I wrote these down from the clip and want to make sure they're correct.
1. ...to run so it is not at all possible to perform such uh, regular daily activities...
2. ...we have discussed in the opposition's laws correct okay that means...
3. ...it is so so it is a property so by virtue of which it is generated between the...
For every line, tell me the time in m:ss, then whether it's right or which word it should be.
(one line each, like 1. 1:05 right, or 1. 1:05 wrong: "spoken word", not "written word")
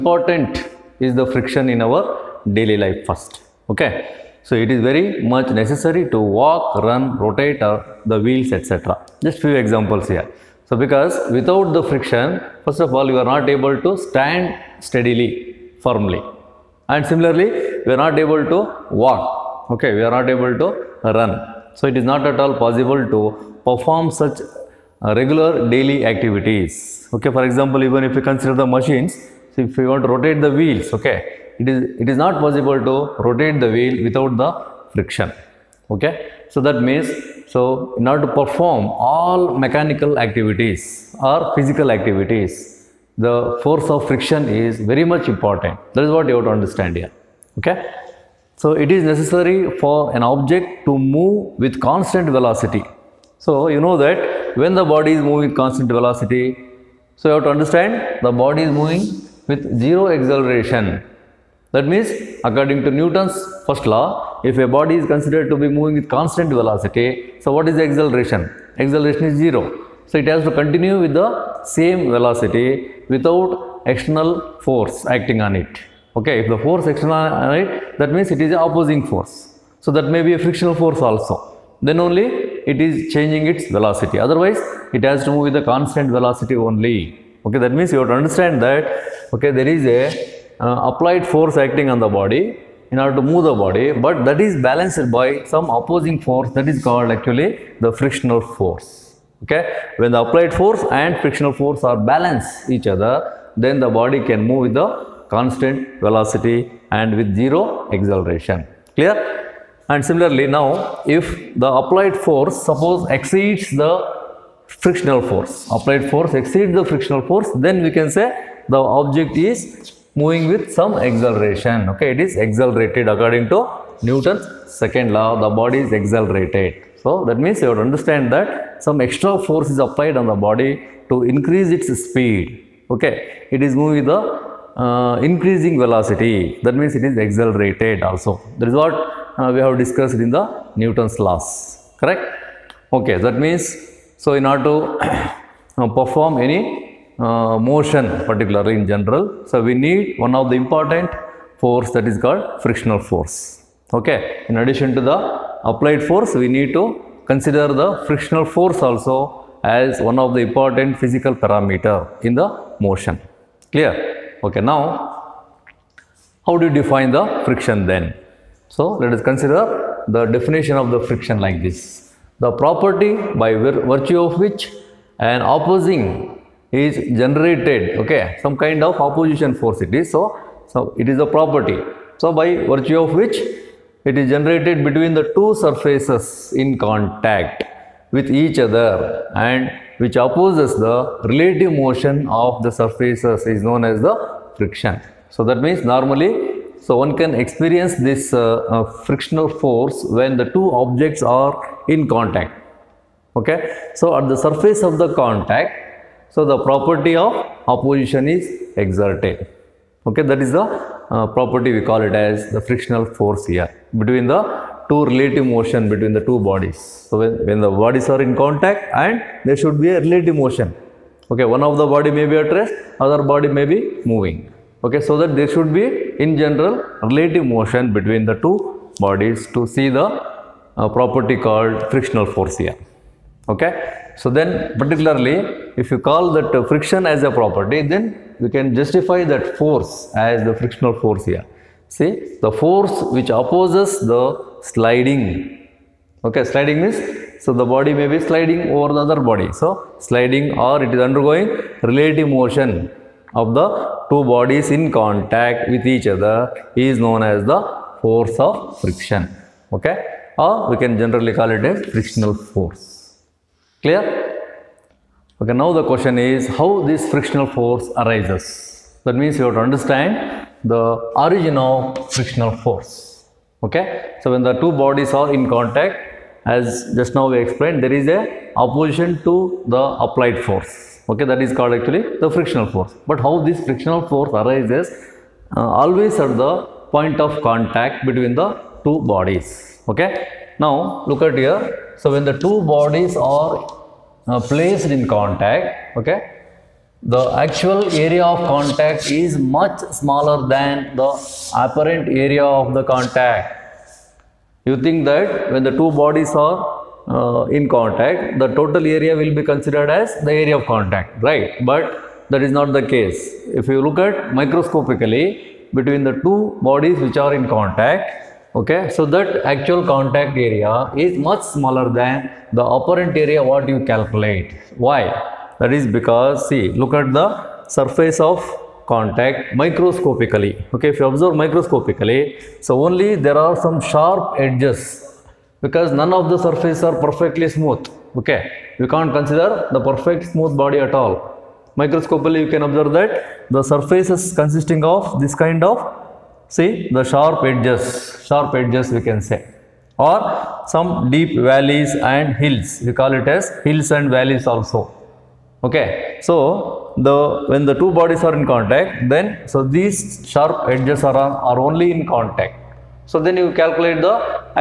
1. 0:20 right
2. 2:19 wrong: "newton", not "opposition"
3. 2:59 right.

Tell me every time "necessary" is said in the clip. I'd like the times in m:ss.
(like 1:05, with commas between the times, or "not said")
0:05, 0:49.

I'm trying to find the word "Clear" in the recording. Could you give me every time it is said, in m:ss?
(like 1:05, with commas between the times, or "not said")
1:48, 2:43, 4:23.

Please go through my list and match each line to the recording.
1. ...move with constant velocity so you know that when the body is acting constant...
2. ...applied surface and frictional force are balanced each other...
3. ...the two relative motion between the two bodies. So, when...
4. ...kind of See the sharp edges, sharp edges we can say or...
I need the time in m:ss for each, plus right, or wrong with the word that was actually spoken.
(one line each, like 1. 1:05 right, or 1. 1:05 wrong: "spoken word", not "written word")
1. 0:50 wrong: "moving", not "acting"
2. 1:40 wrong: "force", not "surface"
3. 3:34 right
4. 5:45 right.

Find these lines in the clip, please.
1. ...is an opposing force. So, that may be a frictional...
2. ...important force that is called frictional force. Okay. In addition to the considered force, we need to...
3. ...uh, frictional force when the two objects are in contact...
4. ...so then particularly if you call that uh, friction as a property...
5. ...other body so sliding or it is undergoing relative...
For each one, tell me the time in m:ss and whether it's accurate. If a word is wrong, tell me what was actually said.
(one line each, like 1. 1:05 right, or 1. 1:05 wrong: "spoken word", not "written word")
1. 1:18 right
2. 2:30 wrong: "applied", not "considered"
3. 3:18 right
4. 3:54 right
5. 4:09 right.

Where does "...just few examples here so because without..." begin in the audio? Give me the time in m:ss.
0:09.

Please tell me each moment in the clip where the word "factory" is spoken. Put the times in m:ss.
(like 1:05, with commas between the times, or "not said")
not said.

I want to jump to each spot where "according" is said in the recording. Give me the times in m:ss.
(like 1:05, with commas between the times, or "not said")
1:02, 2:03.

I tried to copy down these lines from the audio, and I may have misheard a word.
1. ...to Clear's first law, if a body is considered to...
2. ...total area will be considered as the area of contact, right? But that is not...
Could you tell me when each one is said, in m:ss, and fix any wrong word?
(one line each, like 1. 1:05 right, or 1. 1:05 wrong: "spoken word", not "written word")
1. 1:02 wrong: "Newton", not "Clear"
2. 5:08 right.